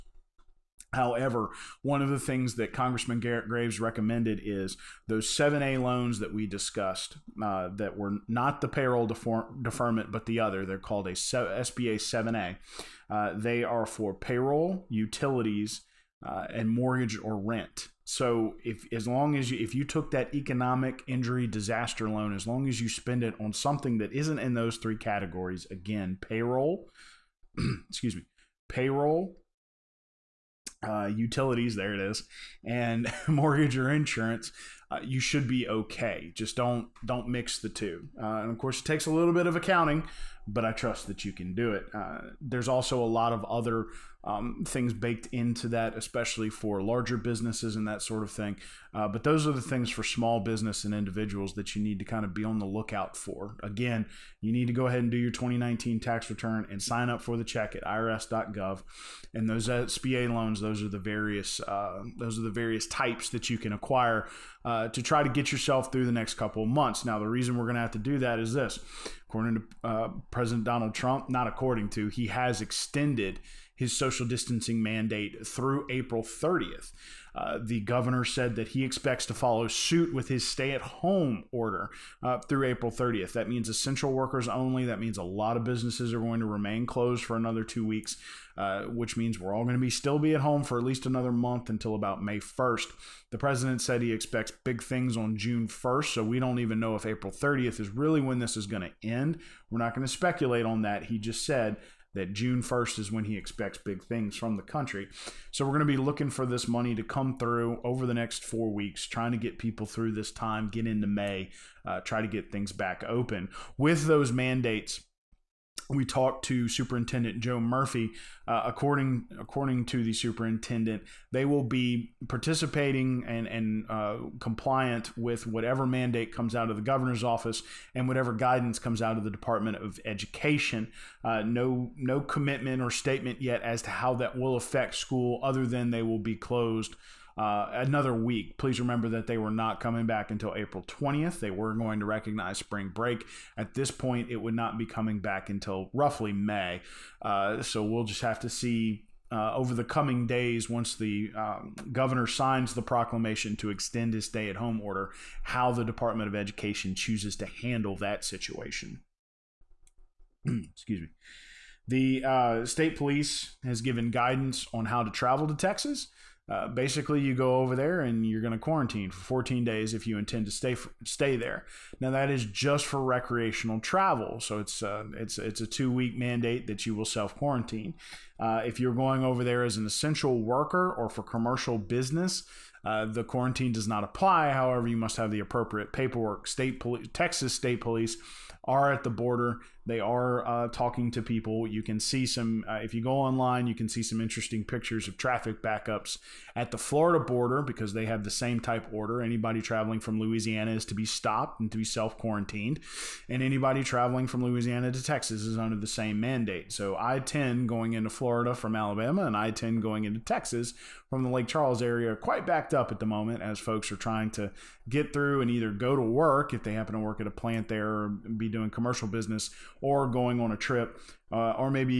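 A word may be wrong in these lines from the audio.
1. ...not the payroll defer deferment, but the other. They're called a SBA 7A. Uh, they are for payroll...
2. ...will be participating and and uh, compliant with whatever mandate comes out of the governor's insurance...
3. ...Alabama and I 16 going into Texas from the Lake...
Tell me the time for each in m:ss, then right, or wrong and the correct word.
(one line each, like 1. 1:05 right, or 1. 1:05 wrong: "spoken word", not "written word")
1. 0:08 right
2. 2:01 wrong: "office", not "insurance"
3. 3:28 wrong: "10", not "16".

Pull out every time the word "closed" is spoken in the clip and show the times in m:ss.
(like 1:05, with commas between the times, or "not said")
1:26, 2:16.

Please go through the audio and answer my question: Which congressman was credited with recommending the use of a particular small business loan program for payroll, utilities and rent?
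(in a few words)
Garrett Graves.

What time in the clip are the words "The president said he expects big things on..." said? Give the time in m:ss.
1:33.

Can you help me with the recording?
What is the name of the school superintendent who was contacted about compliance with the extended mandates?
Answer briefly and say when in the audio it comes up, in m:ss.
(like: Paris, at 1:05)
Joe Murphy, at 1:57.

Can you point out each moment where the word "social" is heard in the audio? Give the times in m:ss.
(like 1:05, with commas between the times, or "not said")
1:13.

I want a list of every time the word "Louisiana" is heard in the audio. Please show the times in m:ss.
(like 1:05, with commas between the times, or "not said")
3:20, 3:24.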